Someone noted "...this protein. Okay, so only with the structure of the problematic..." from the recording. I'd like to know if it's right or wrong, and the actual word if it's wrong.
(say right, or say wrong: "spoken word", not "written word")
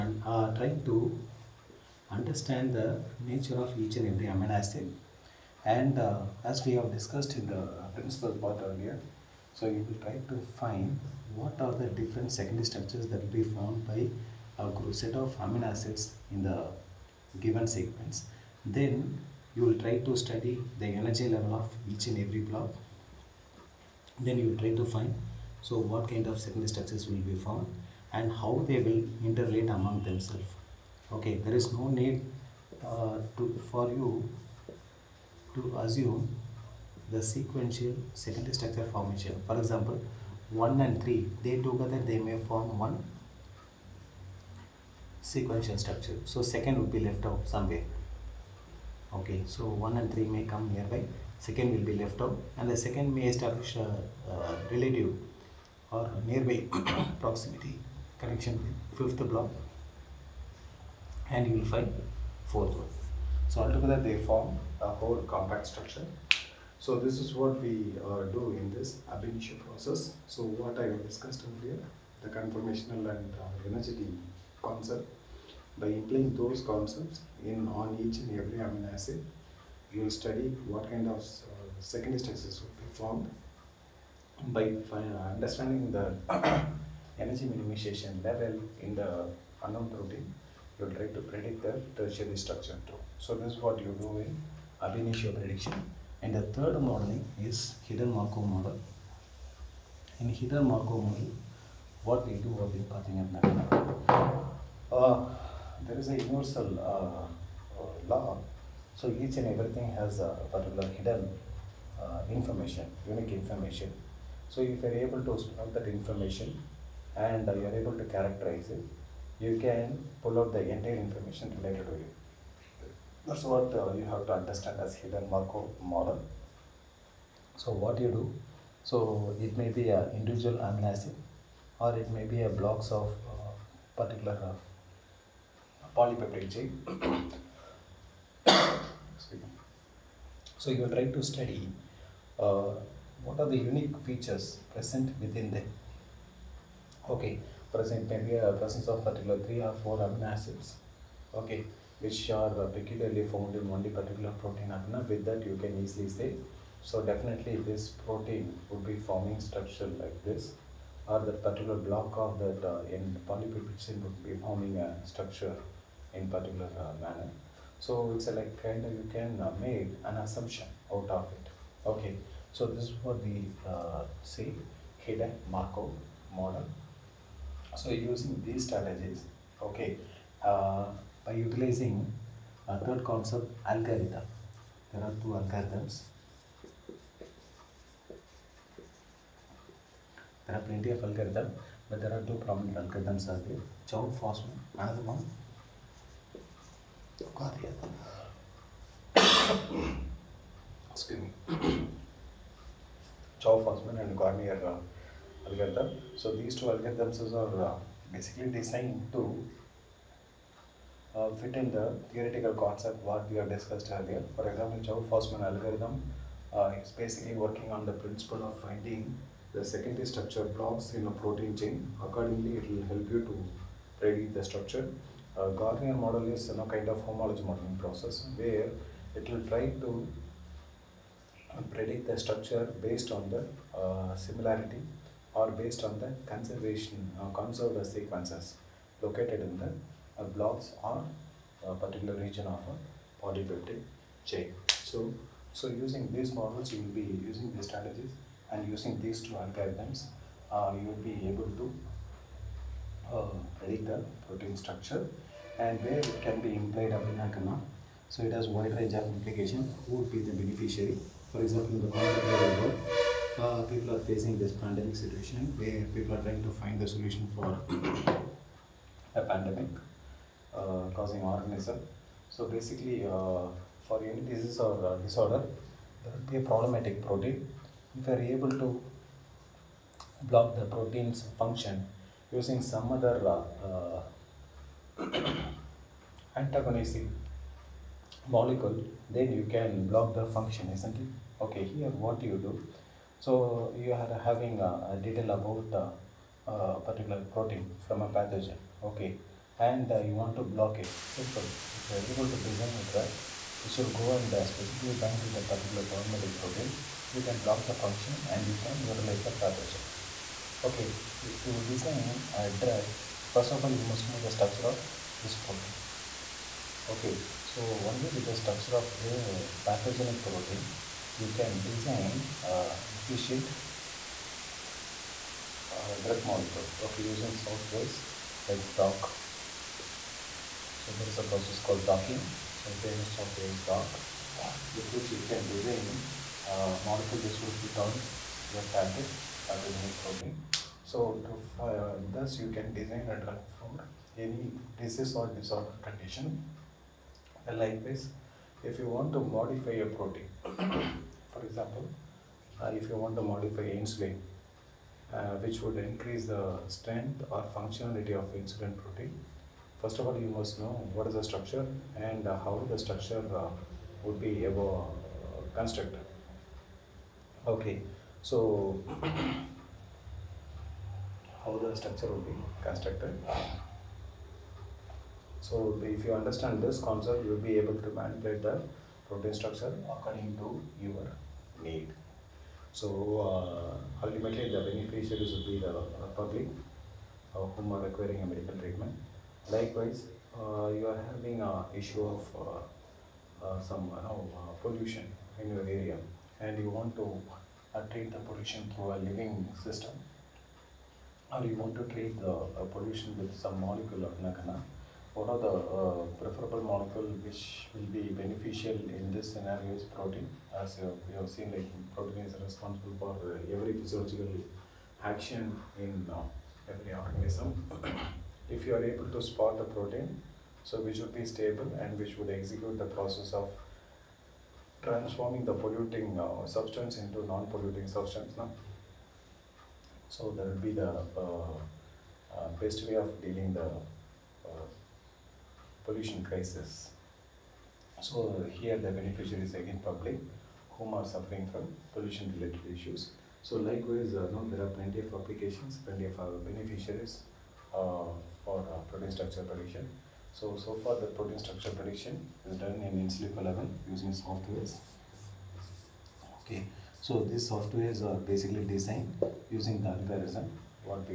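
wrong: "pathogenic", not "problematic".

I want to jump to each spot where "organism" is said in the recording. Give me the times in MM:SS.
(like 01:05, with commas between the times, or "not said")
04:31, 06:56.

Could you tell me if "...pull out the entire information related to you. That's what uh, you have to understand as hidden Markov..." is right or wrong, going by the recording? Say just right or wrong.
right.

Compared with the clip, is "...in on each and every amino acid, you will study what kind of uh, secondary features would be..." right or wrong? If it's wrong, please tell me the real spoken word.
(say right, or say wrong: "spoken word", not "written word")
wrong: "structures", not "features".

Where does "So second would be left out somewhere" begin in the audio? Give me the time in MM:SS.
00:46.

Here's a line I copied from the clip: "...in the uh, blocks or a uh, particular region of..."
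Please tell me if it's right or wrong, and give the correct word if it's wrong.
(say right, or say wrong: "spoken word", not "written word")
right.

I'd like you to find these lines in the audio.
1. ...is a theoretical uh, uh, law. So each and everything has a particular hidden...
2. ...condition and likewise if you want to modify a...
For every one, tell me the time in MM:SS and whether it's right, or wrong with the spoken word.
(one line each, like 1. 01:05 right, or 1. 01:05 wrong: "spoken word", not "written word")
1. 01:46 wrong: "universal", not "theoretical"
2. 05:45 right.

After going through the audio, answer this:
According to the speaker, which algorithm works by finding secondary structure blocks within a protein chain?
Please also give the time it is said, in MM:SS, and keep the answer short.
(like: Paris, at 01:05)
Chou-Fasman, at 03:34.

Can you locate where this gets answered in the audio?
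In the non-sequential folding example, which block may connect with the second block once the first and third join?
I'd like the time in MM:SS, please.
00:59.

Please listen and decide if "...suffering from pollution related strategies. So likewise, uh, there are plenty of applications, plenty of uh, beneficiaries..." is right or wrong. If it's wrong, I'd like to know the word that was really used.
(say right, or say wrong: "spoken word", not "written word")
wrong: "issues", not "strategies".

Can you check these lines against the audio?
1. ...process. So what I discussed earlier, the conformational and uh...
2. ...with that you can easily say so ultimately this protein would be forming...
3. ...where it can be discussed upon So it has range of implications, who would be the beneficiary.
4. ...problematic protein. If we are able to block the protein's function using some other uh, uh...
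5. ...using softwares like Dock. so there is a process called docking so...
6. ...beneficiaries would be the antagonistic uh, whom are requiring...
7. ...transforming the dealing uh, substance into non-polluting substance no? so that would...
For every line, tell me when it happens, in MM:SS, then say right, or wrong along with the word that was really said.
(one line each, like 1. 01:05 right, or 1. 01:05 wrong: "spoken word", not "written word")
1. 01:09 right
2. 02:35 wrong: "definitely", not "ultimately"
3. 04:15 wrong: "implied", not "discussed"
4. 04:36 right
5. 05:27 right
6. 06:24 wrong: "public", not "antagonistic"
7. 07:04 wrong: "polluting", not "dealing".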